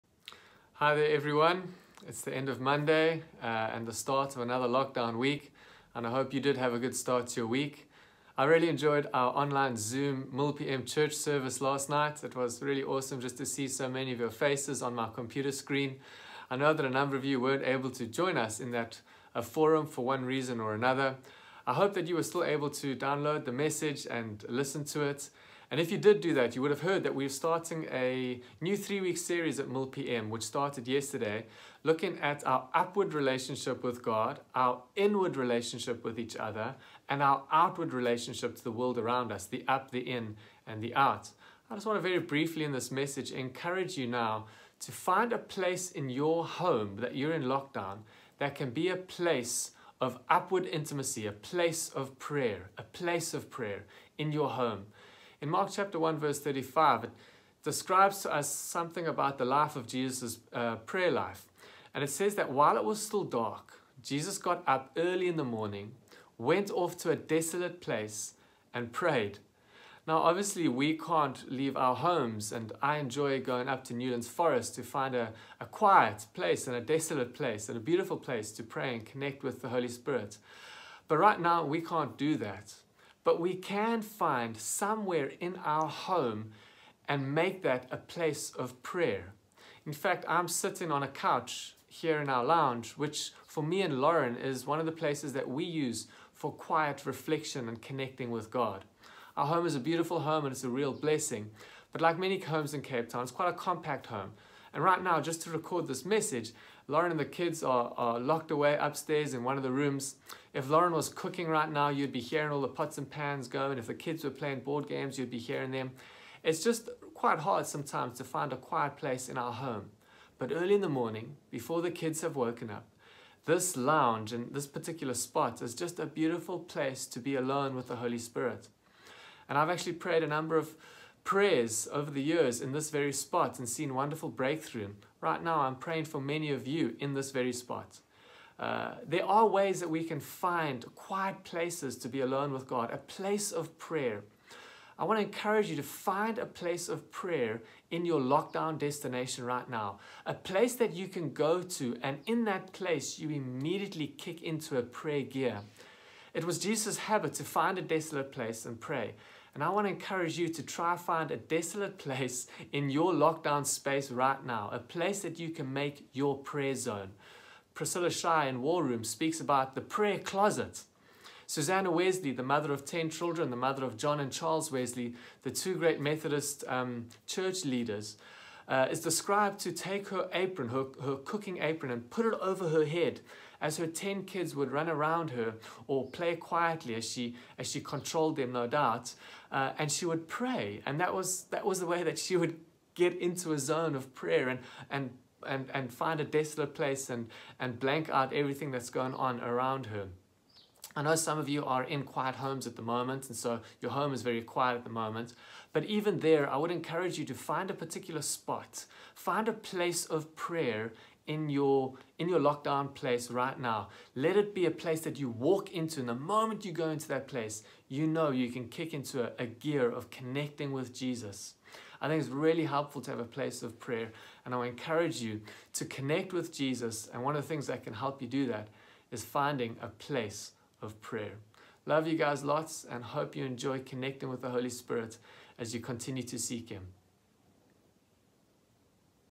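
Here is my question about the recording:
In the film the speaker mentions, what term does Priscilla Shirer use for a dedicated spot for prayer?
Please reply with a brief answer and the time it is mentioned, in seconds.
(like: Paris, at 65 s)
prayer closet, at 169 s.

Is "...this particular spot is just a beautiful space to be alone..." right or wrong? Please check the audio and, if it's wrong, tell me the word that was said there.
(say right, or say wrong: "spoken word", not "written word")
wrong: "place", not "space".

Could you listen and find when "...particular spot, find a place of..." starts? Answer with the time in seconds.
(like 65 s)
207 s.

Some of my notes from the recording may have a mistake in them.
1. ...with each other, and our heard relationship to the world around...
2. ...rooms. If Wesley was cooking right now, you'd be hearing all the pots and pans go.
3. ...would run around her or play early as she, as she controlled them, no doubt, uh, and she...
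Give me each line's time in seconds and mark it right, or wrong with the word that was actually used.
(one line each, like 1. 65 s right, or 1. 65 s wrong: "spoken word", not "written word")
1. 36 s wrong: "outward", not "heard"
2. 109 s wrong: "Lauren", not "Wesley"
3. 184 s wrong: "quietly", not "early".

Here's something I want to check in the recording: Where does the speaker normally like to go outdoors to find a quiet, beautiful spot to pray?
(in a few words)
Newlands Forest.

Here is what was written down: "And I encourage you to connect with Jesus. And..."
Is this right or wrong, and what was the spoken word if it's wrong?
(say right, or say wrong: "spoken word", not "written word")
right.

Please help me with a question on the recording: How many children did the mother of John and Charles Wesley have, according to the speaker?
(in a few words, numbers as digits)
10.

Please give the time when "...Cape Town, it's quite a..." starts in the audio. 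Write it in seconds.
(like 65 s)
102 s.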